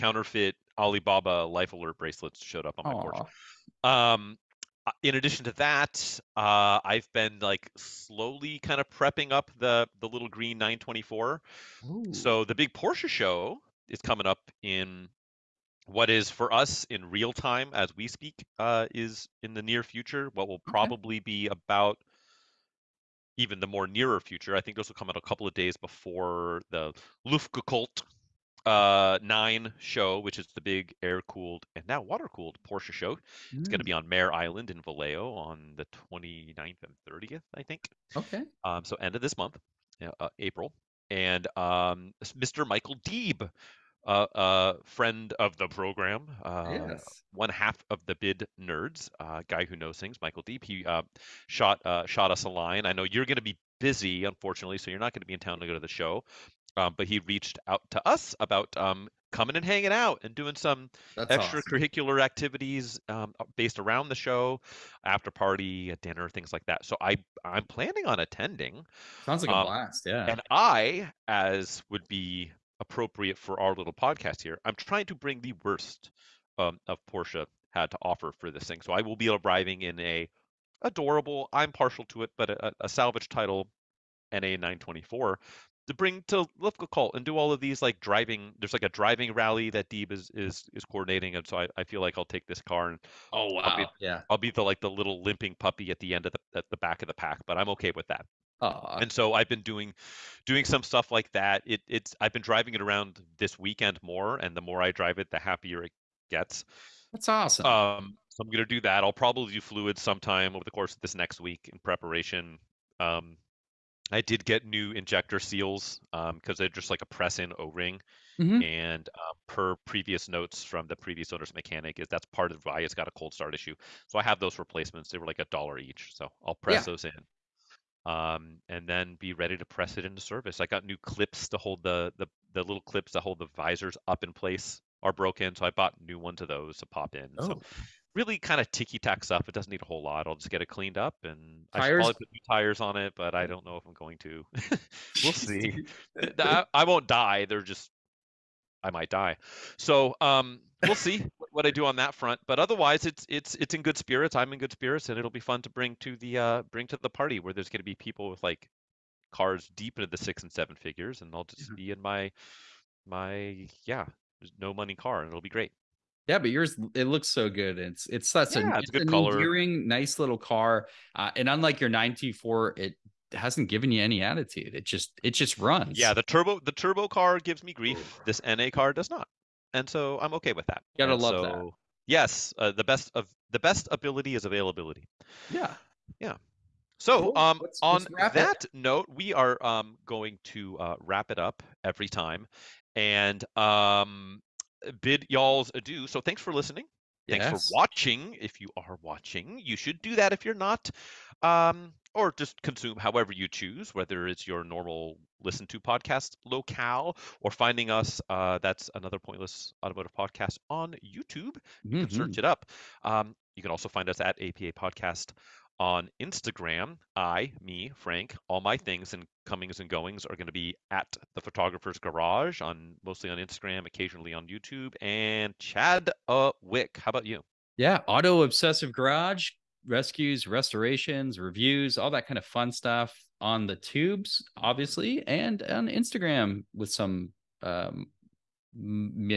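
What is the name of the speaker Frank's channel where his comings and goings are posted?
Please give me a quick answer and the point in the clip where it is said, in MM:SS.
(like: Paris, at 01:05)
The Photographer's Garage, at 03:41.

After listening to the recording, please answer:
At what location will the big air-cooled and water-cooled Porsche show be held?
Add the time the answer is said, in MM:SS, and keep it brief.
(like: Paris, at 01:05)
Mare Island, at 00:34.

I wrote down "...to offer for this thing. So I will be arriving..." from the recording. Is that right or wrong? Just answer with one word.
right.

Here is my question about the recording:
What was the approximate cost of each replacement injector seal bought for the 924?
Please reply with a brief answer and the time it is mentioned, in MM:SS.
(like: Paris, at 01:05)
a dollar, at 02:05.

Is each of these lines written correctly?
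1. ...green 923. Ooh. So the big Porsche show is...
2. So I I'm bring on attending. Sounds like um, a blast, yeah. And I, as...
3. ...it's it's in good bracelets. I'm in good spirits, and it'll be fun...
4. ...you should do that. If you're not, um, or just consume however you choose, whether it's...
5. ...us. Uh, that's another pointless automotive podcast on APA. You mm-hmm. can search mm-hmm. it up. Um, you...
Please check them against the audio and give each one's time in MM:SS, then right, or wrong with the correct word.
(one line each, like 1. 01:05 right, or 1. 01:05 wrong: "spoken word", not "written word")
1. 00:10 wrong: "924", not "923"
2. 01:06 wrong: "planning", not "bring"
3. 02:33 wrong: "spirits", not "bracelets"
4. 03:19 right
5. 03:27 wrong: "YouTube", not "APA".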